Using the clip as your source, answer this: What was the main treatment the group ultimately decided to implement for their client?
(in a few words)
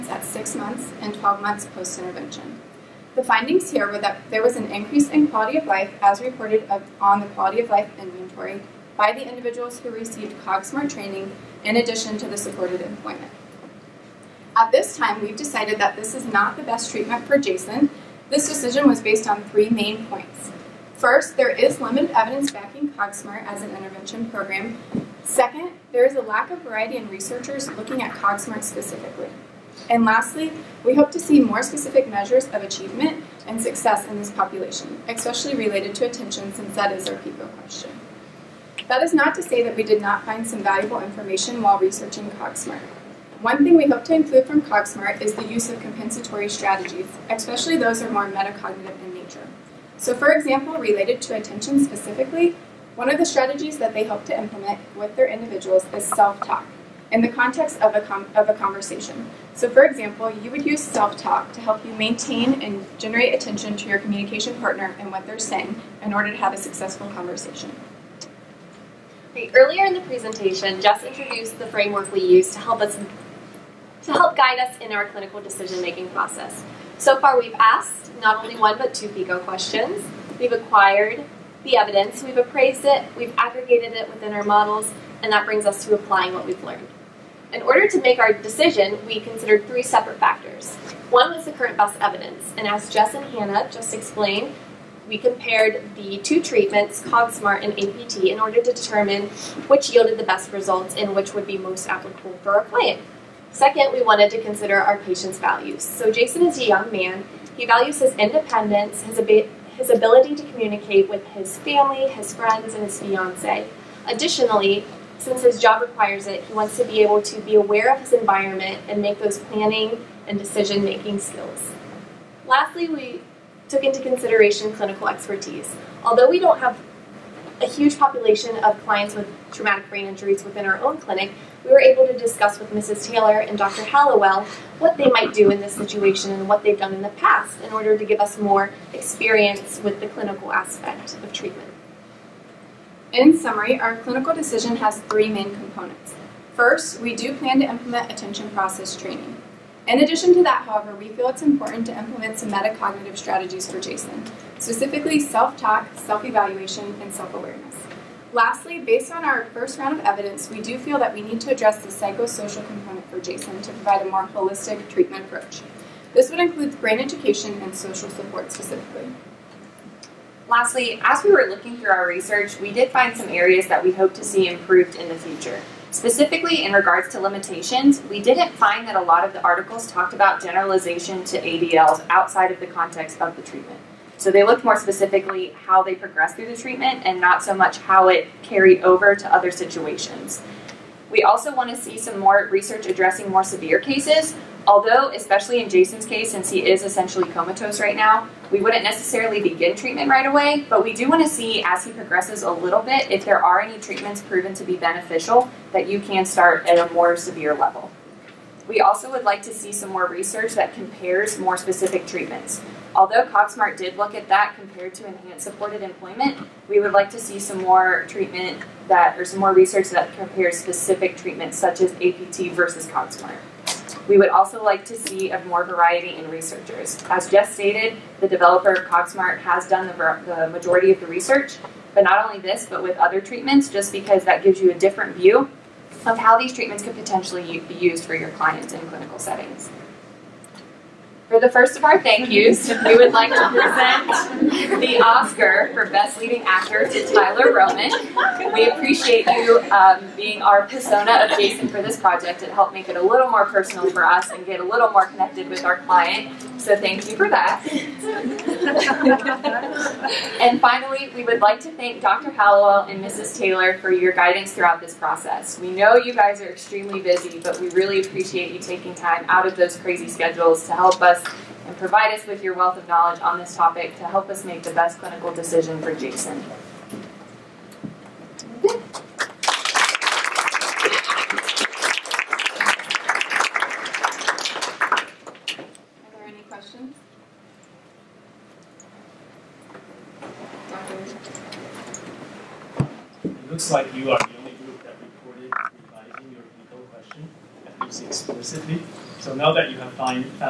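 Attention process training.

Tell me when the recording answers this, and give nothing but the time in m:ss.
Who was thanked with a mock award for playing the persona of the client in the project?
4:07.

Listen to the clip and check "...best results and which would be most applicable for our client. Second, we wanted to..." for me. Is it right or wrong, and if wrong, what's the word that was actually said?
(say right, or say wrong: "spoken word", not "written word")
right.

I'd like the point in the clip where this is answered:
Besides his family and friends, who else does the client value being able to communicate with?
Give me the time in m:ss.
1:52.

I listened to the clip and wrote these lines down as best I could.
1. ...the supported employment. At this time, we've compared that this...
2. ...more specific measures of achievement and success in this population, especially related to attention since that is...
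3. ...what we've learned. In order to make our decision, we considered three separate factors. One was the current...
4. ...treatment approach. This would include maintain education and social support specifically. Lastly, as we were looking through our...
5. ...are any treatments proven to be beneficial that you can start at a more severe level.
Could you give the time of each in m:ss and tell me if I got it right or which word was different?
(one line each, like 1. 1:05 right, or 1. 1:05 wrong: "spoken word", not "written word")
1. 0:12 wrong: "decided", not "compared"
2. 0:31 right
3. 1:26 right
4. 2:44 wrong: "brain", not "maintain"
5. 3:23 right.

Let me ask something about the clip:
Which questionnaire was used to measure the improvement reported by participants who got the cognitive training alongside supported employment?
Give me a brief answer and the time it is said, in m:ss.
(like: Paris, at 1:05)
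Quality of life inventory, at 0:07.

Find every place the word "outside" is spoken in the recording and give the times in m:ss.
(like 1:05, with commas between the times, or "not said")
3:02.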